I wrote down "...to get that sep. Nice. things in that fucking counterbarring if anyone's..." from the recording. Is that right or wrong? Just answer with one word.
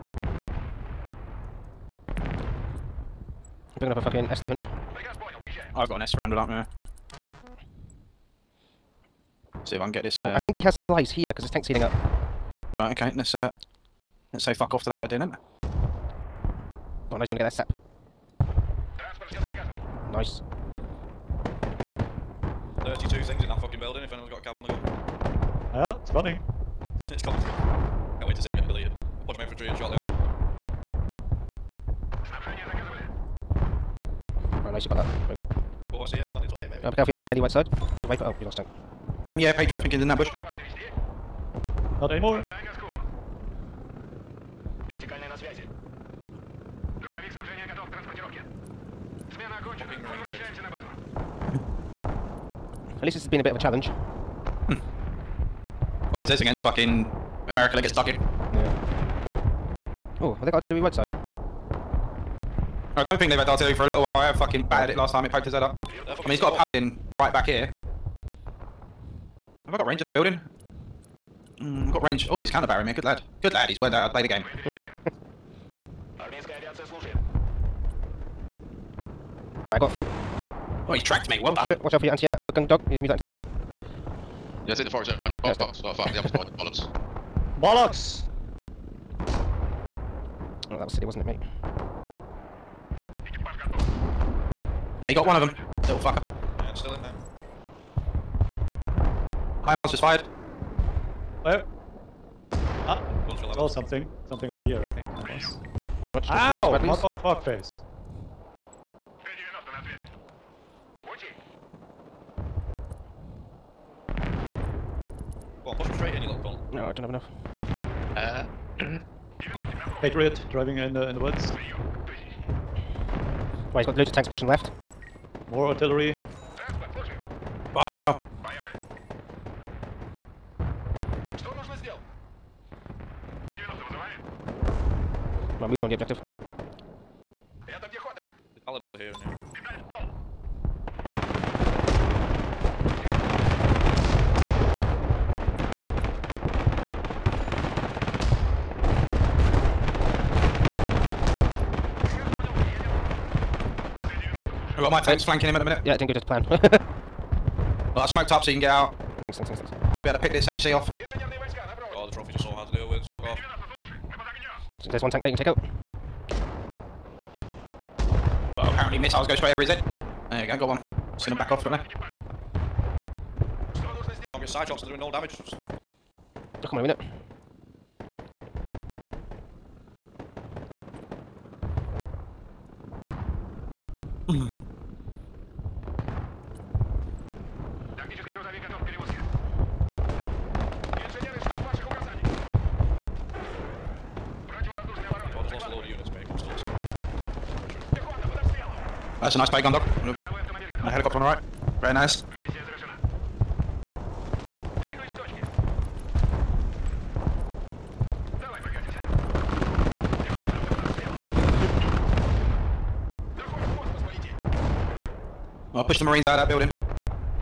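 wrong.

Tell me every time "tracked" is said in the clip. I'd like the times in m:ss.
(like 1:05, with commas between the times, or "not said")
1:21.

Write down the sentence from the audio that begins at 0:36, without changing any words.
Uh, be careful, he has got a heli right side.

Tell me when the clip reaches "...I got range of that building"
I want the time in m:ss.
1:09.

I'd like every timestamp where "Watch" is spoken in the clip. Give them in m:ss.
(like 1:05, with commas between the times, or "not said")
1:21, 1:46.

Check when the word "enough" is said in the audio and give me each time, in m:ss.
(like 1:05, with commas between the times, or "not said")
1:57.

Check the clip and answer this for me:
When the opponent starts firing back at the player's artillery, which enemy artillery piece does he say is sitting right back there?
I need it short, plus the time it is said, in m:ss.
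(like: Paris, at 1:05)
Paladin, at 1:06.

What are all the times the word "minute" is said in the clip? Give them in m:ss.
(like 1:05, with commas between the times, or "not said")
2:35, 2:56.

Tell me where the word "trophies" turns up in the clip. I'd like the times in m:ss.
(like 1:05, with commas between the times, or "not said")
2:42.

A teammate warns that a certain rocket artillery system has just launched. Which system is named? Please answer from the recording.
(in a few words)
HIMARS.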